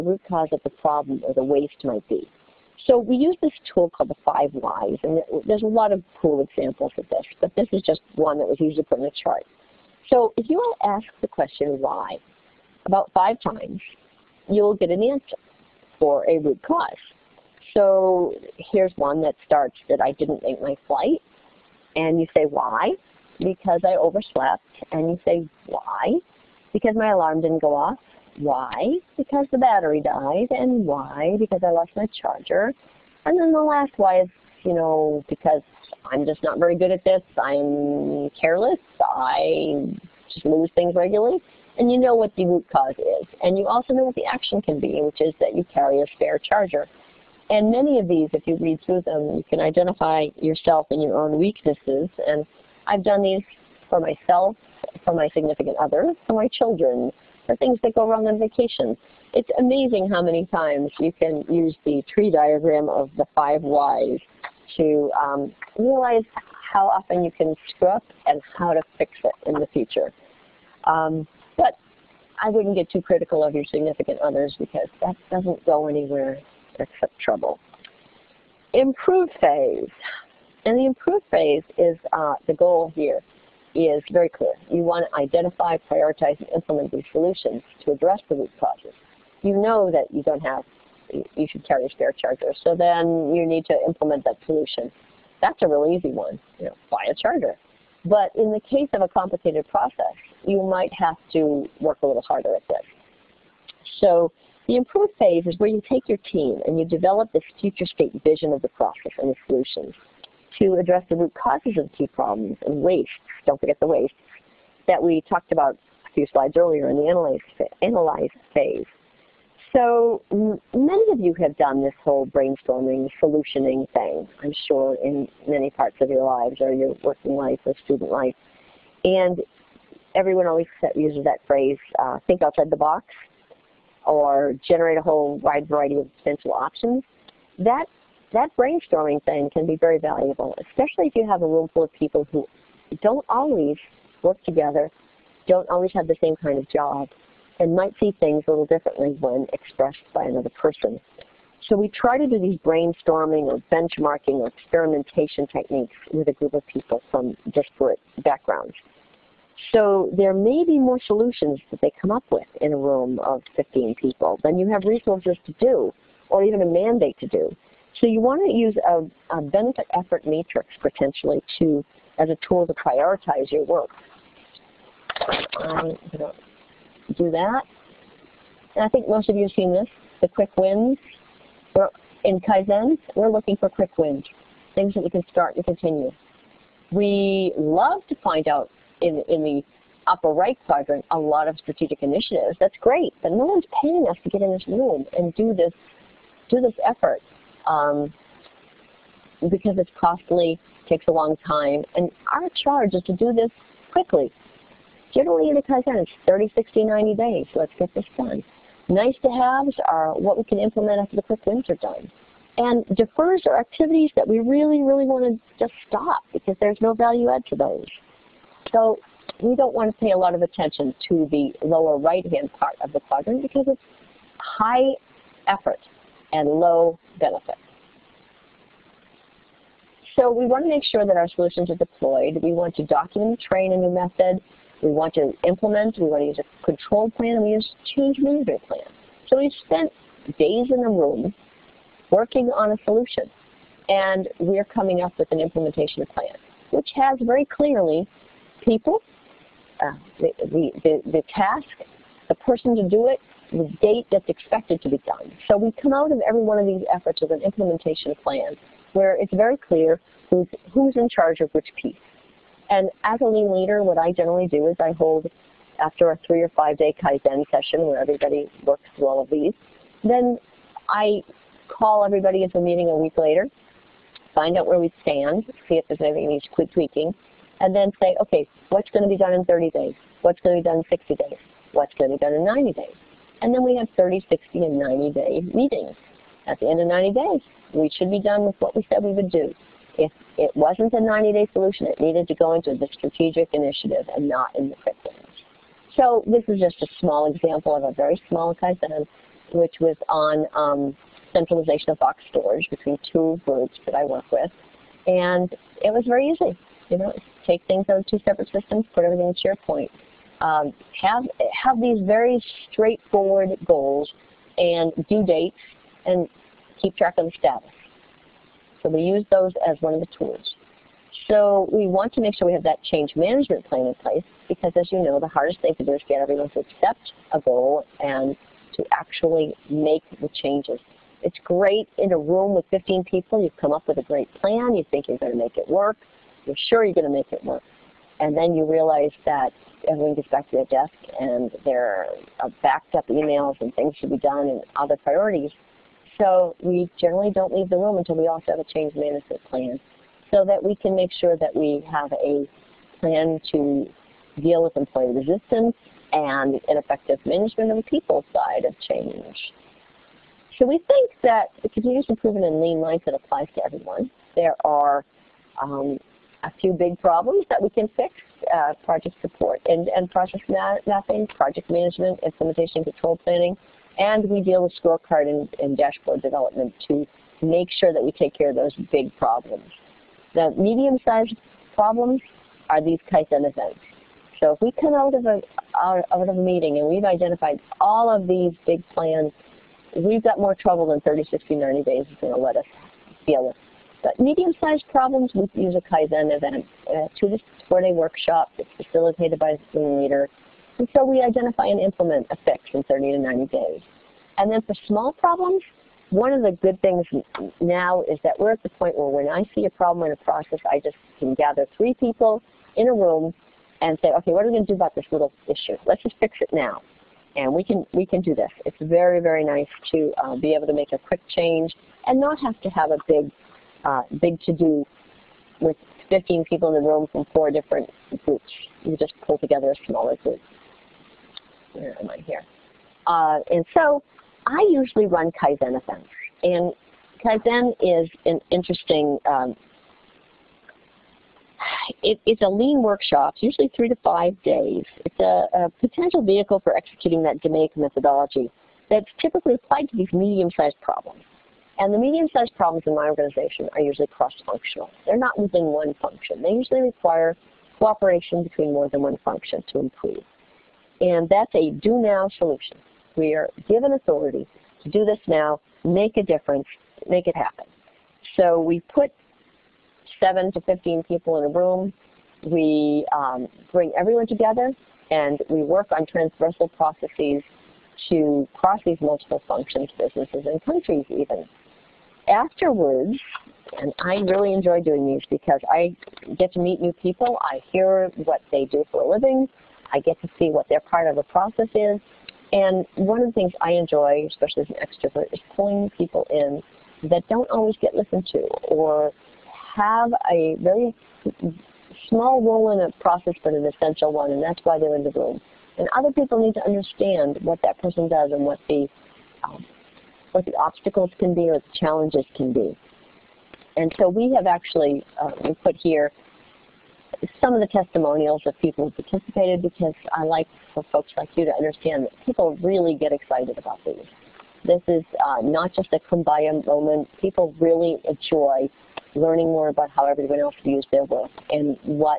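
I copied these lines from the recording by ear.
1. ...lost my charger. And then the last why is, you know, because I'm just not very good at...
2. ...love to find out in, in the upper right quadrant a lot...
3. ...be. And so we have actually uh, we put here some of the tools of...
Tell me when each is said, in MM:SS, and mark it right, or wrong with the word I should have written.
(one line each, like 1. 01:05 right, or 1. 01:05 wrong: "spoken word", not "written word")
1. 00:31 right
2. 03:07 right
3. 08:32 wrong: "testimonials", not "tools".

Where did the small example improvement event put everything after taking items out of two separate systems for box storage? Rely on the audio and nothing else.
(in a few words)
SharePoint.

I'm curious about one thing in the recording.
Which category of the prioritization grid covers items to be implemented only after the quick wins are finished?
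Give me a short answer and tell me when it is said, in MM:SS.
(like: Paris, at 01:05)
Nice to haves, at 03:28.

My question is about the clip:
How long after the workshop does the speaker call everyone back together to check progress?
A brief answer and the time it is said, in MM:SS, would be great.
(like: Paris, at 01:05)
A week later, at 04:32.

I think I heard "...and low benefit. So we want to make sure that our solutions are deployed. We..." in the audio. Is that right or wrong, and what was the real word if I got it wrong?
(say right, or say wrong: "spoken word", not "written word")
right.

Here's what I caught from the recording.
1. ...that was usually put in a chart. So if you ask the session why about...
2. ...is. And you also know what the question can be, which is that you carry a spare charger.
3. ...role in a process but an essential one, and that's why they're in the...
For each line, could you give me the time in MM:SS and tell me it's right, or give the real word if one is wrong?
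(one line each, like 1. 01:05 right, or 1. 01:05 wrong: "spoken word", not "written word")
1. 00:08 wrong: "question", not "session"
2. 00:42 wrong: "action", not "question"
3. 08:22 right.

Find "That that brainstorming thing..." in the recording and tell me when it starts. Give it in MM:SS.
02:17.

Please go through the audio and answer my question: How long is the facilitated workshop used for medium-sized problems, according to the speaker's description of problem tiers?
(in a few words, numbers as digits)
2 to 4 days.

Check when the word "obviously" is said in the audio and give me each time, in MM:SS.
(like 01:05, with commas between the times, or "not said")
not said.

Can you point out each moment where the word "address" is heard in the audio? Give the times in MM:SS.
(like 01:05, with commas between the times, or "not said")
01:27, 01:50.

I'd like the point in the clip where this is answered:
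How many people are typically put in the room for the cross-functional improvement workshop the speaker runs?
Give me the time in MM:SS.
07:50.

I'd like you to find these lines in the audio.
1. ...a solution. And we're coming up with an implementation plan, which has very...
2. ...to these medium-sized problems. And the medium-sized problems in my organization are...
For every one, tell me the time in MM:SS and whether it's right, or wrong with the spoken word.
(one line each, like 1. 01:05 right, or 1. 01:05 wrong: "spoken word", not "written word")
1. 04:02 right
2. 07:29 right.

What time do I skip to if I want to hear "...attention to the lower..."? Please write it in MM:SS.
03:40.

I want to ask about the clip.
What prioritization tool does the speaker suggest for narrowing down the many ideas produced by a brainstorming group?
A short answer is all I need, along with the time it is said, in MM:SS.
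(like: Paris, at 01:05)
Benefit effort matrix, at 02:49.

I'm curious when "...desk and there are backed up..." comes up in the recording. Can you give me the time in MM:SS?
05:40.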